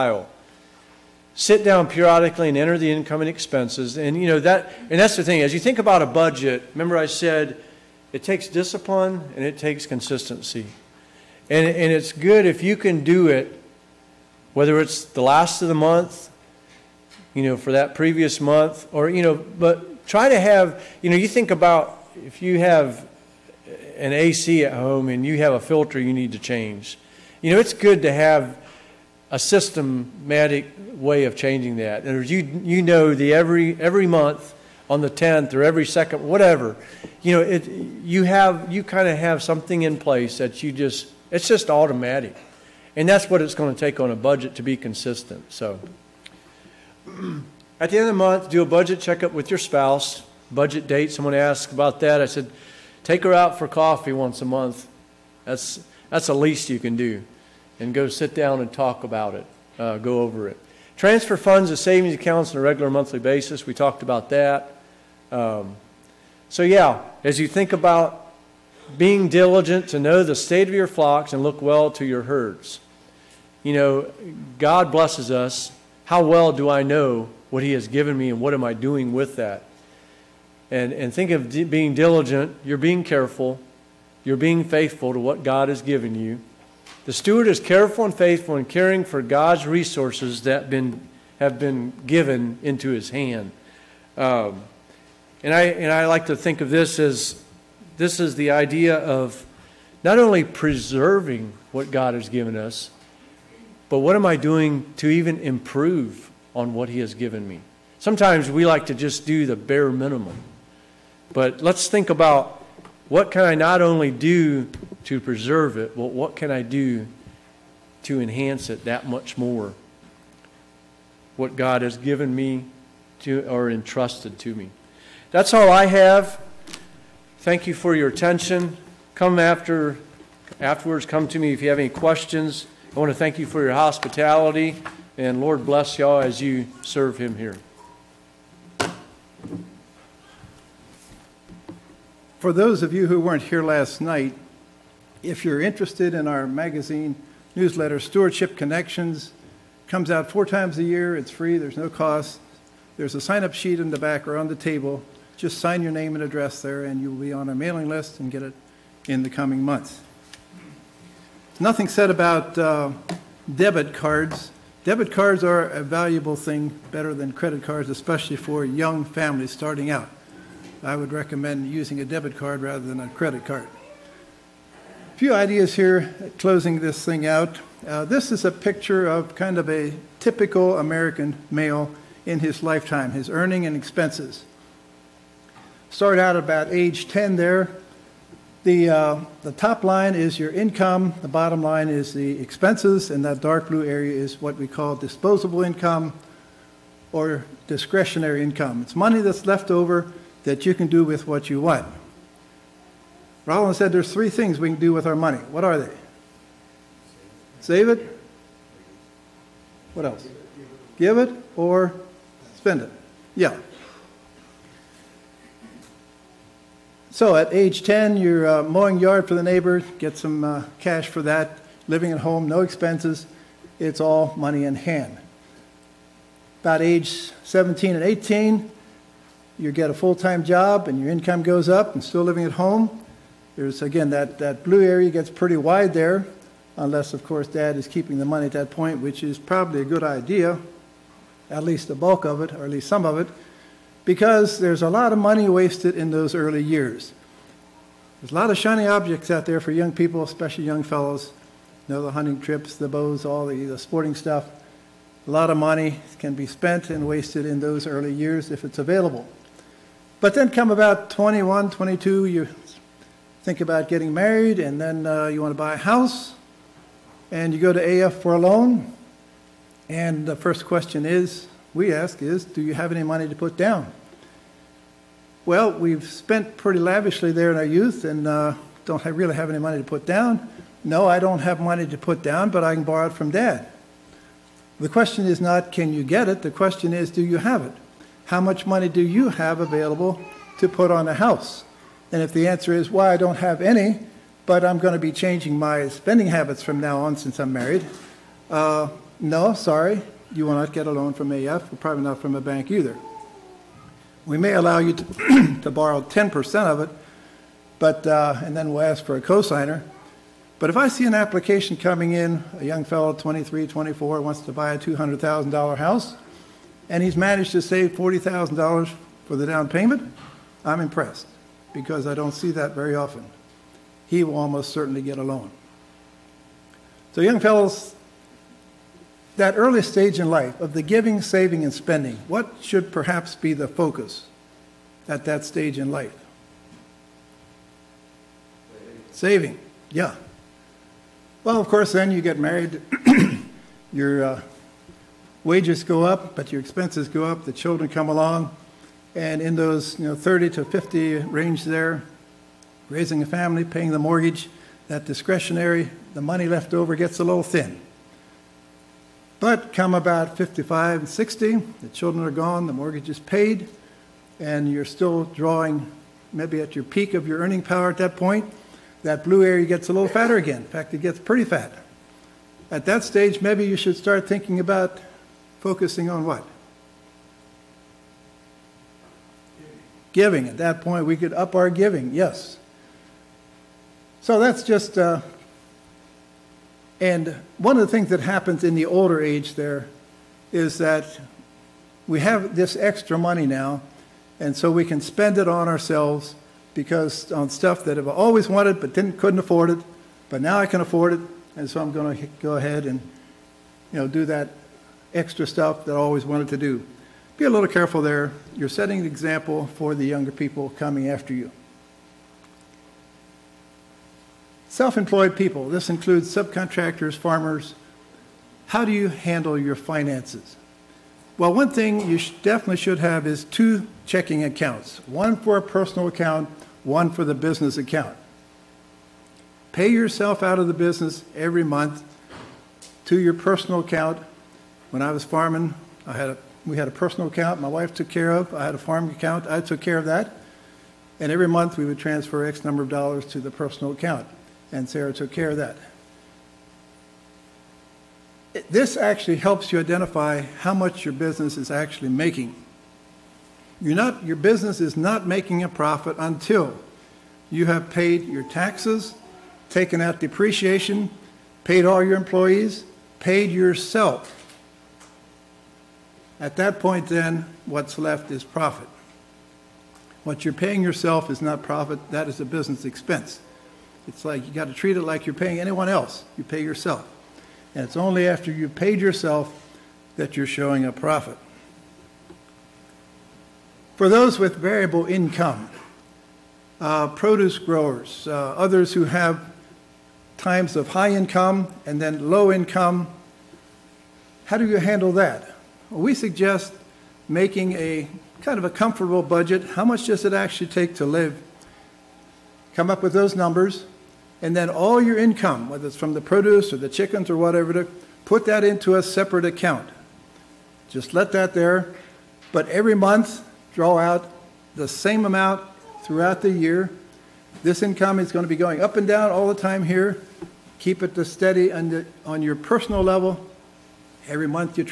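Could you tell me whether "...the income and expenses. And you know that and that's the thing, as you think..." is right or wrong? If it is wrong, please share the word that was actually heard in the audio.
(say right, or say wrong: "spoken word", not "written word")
right.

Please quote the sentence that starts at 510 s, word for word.
Just let that there, but every month draw out the same amount throughout the year.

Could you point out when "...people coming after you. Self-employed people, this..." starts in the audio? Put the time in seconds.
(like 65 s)
410 s.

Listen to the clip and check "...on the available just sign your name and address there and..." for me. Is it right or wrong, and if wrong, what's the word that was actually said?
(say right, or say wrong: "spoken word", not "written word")
wrong: "table", not "available".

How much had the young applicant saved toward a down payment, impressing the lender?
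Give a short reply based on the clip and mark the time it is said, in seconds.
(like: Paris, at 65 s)
$40,000, at 317 s.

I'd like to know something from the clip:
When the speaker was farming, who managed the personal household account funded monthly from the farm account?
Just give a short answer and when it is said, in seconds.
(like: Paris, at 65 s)
Sarah, at 444 s.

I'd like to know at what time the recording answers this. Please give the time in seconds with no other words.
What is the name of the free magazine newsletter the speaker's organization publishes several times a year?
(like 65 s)
148 s.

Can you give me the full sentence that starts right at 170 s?
I would recommend using a debit card rather than a credit card.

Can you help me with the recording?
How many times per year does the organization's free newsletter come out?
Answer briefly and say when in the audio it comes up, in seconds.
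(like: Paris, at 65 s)
4, at 150 s.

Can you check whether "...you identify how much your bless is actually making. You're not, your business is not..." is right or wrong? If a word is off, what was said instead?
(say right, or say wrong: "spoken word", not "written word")
wrong: "business", not "bless".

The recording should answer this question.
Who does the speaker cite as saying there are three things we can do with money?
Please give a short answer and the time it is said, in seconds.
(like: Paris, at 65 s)
Rollins, at 203 s.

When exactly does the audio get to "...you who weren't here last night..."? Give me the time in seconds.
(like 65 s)
142 s.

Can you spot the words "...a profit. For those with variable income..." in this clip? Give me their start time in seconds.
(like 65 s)
480 s.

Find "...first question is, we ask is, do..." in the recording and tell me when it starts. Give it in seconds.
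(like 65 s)
270 s.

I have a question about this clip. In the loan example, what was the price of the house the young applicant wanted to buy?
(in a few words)
$200,000.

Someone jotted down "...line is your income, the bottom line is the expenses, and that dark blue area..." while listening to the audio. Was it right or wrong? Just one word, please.
right.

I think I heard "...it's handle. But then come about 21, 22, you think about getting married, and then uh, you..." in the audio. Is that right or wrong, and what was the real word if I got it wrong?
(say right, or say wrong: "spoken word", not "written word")
wrong: "available", not "handle".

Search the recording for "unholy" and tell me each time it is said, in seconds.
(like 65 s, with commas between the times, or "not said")
not said.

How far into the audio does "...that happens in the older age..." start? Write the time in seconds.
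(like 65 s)
388 s.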